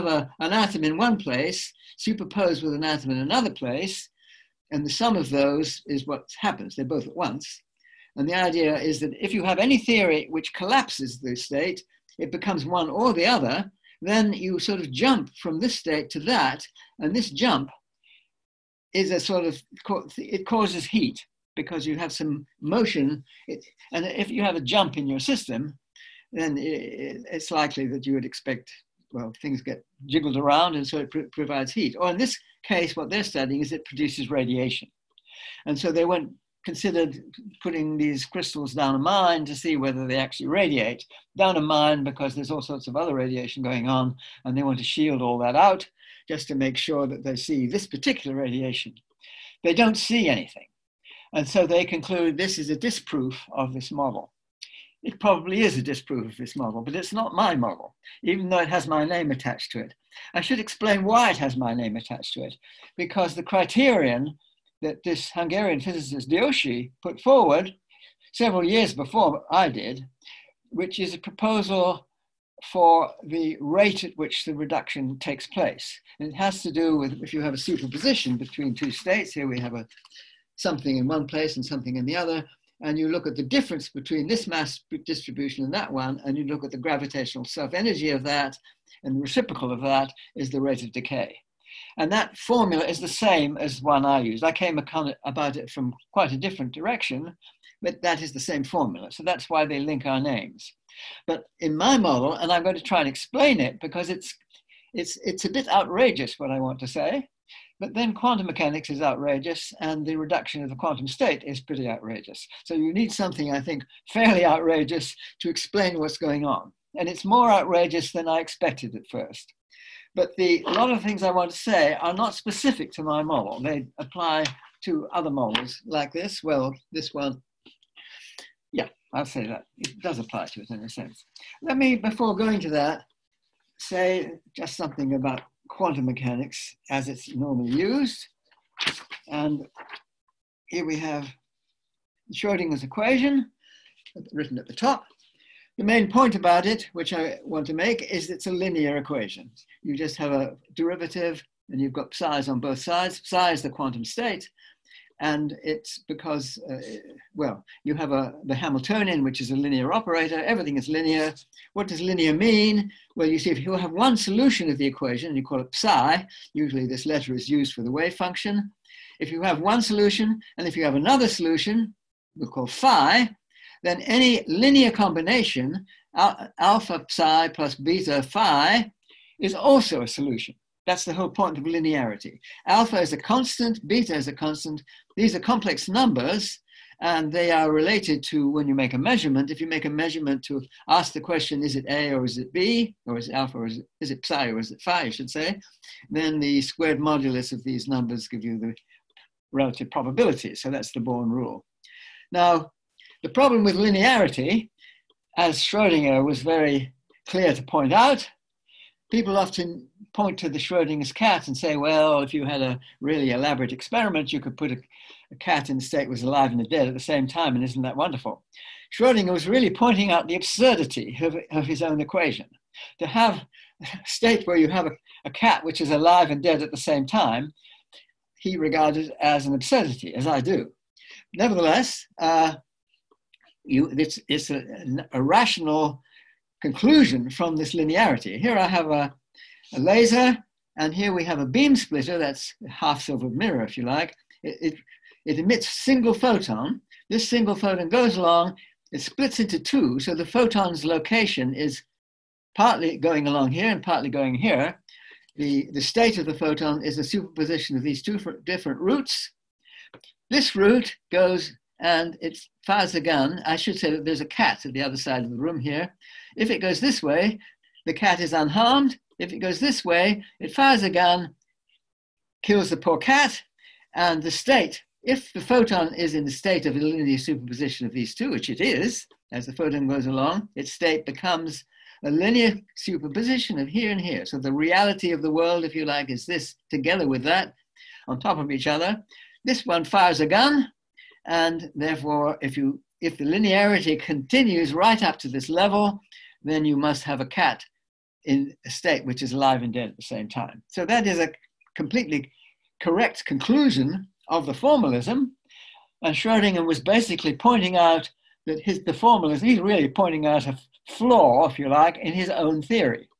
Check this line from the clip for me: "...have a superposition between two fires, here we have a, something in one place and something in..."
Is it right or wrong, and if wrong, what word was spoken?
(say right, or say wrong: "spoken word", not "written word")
wrong: "states", not "fires".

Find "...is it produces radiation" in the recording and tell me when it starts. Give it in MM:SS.
00:33.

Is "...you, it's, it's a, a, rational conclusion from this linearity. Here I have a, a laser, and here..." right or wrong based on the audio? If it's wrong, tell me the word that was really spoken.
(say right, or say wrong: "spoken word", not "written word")
right.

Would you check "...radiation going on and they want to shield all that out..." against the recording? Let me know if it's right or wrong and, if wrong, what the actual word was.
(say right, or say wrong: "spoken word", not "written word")
right.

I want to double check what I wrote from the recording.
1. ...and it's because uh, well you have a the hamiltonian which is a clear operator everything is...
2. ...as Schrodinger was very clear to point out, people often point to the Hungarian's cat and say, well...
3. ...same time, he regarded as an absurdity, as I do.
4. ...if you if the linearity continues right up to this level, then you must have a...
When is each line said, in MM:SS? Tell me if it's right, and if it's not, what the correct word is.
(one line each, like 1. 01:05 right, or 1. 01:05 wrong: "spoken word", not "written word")
1. 02:35 wrong: "linear", not "clear"
2. 03:25 wrong: "Schrodinger", not "Hungarian"
3. 03:46 right
4. 04:52 right.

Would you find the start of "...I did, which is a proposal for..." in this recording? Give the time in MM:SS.
01:09.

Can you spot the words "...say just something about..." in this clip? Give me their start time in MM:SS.
02:13.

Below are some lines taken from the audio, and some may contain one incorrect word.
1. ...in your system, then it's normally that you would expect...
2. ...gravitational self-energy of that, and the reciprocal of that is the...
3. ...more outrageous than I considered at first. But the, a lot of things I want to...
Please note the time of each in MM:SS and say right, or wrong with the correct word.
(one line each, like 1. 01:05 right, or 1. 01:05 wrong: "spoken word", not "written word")
1. 00:24 wrong: "likely", not "normally"
2. 01:26 right
3. 01:57 wrong: "expected", not "considered".